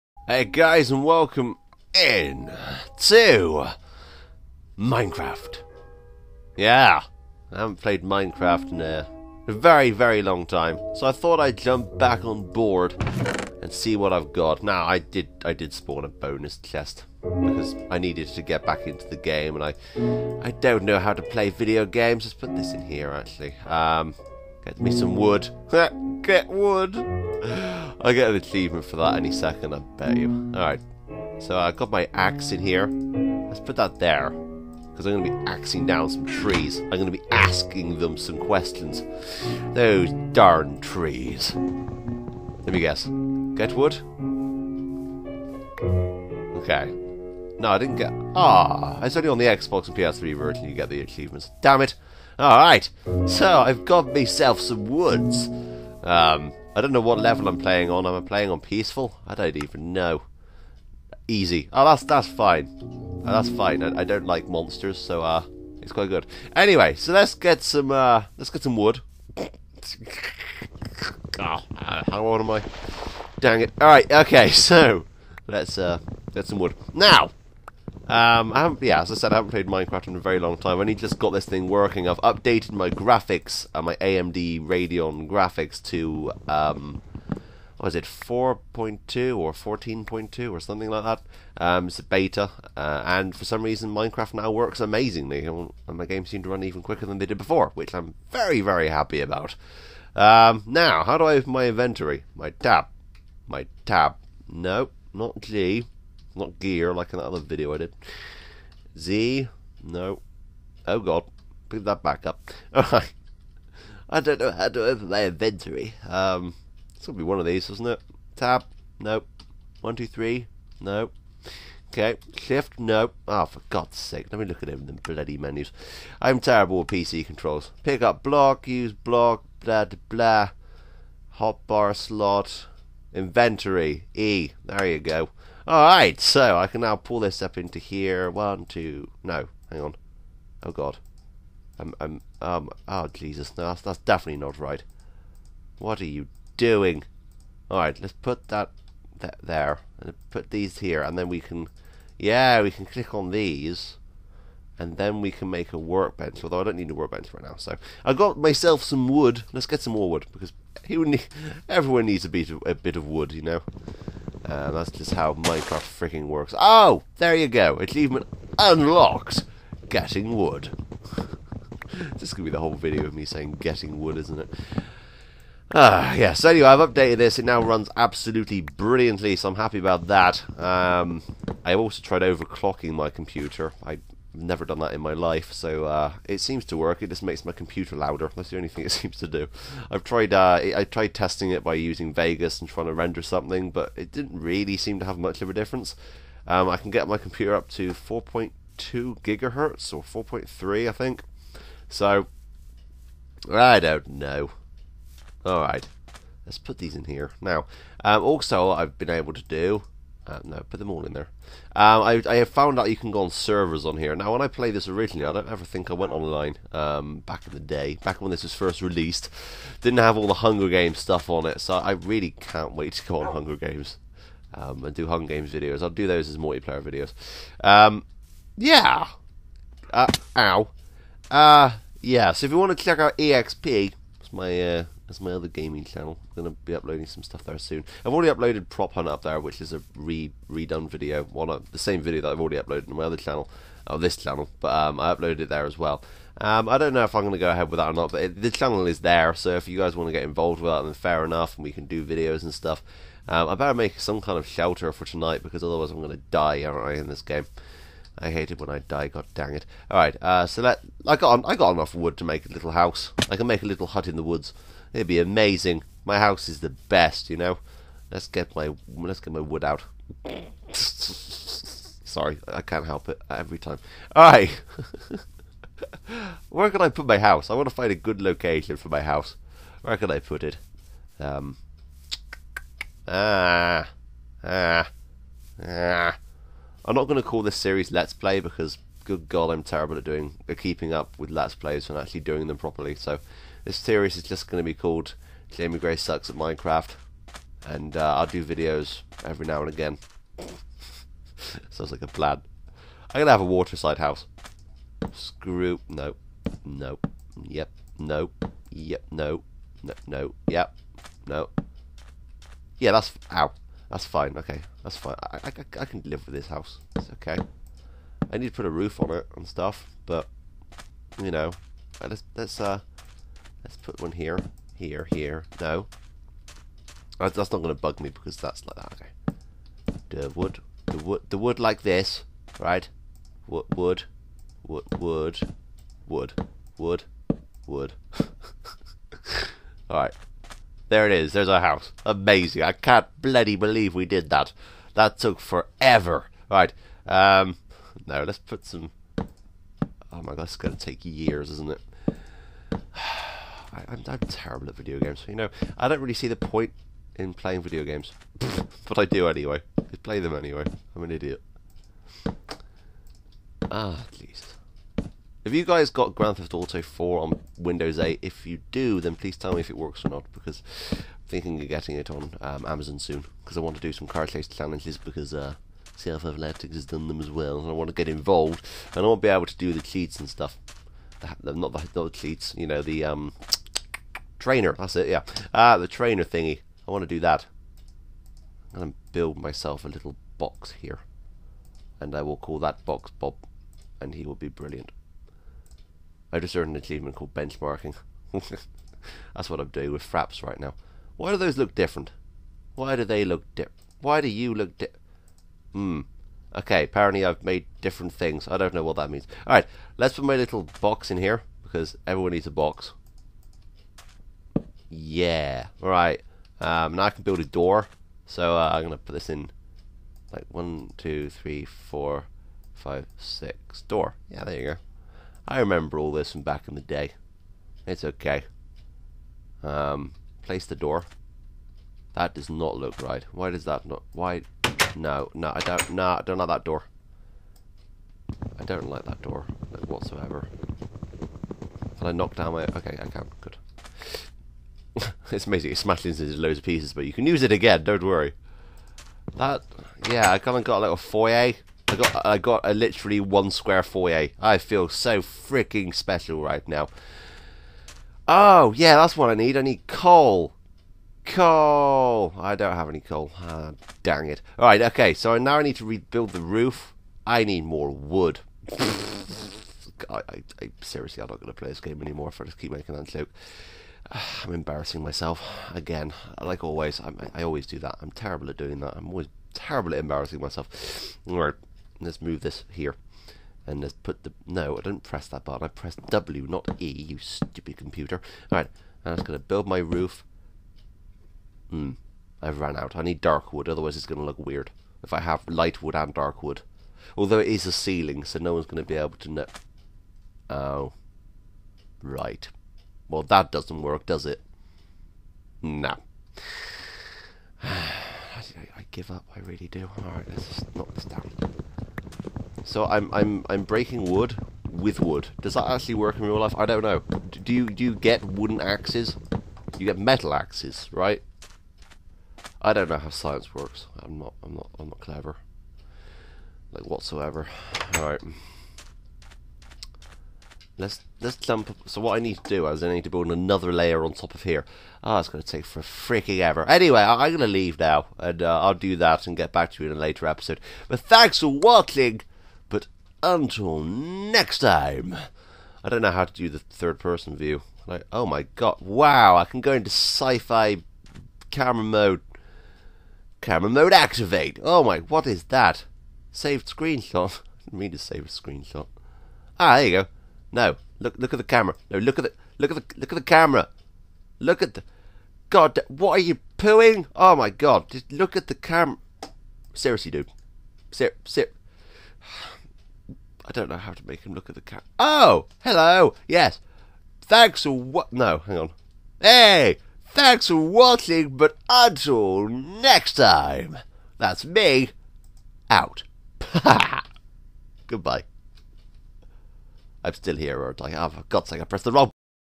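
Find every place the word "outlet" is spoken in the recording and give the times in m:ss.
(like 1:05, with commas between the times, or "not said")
not said.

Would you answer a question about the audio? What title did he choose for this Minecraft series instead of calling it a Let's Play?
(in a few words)
Jamie Gray Sucks at Minecraft.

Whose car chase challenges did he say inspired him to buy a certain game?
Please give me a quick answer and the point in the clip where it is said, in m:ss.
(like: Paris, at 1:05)
CF Athletics, at 6:15.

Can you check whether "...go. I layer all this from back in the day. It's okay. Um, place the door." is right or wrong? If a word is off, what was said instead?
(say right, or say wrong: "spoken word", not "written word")
wrong: "remember", not "layer".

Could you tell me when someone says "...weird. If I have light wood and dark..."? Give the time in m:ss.
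8:14.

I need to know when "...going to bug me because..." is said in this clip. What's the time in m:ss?
5:27.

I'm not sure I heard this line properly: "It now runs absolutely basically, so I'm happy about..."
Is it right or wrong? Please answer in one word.
wrong.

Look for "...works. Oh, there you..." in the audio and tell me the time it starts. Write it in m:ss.
2:46.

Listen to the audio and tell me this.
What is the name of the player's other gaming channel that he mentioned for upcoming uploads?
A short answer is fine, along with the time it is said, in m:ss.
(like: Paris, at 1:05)
EXP, at 3:53.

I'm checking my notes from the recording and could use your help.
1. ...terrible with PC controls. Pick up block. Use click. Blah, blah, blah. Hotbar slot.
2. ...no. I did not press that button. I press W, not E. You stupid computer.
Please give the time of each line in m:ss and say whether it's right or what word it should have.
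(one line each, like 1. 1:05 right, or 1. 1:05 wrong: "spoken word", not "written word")
1. 2:06 wrong: "block", not "click"
2. 8:04 right.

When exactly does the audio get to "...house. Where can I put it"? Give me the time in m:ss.
4:39.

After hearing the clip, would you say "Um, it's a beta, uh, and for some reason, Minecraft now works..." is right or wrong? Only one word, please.
right.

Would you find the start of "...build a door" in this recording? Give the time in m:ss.
6:57.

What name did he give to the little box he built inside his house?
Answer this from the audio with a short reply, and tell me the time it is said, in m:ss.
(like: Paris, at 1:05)
Bob, at 6:33.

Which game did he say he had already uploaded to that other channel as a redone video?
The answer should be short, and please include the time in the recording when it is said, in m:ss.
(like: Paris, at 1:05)
Prop Hunt, at 3:58.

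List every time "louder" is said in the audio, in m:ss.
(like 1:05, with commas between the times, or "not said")
3:07.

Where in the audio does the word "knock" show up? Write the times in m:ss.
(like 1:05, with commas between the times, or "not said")
7:22, 8:30.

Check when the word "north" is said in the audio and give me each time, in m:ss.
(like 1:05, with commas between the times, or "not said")
not said.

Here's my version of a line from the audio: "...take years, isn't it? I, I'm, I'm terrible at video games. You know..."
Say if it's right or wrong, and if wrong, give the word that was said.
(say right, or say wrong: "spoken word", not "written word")
right.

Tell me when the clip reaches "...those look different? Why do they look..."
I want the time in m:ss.
6:41.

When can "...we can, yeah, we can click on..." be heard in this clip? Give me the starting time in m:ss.
2:31.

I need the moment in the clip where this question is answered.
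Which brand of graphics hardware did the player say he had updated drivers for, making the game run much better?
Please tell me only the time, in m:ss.
1:23.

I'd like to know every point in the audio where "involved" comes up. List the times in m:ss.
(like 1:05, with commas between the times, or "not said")
4:10, 6:18.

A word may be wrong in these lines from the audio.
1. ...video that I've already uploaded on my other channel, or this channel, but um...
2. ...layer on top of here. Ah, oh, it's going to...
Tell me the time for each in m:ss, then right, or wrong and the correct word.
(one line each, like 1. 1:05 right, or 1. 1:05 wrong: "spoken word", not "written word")
1. 4:01 right
2. 8:53 right.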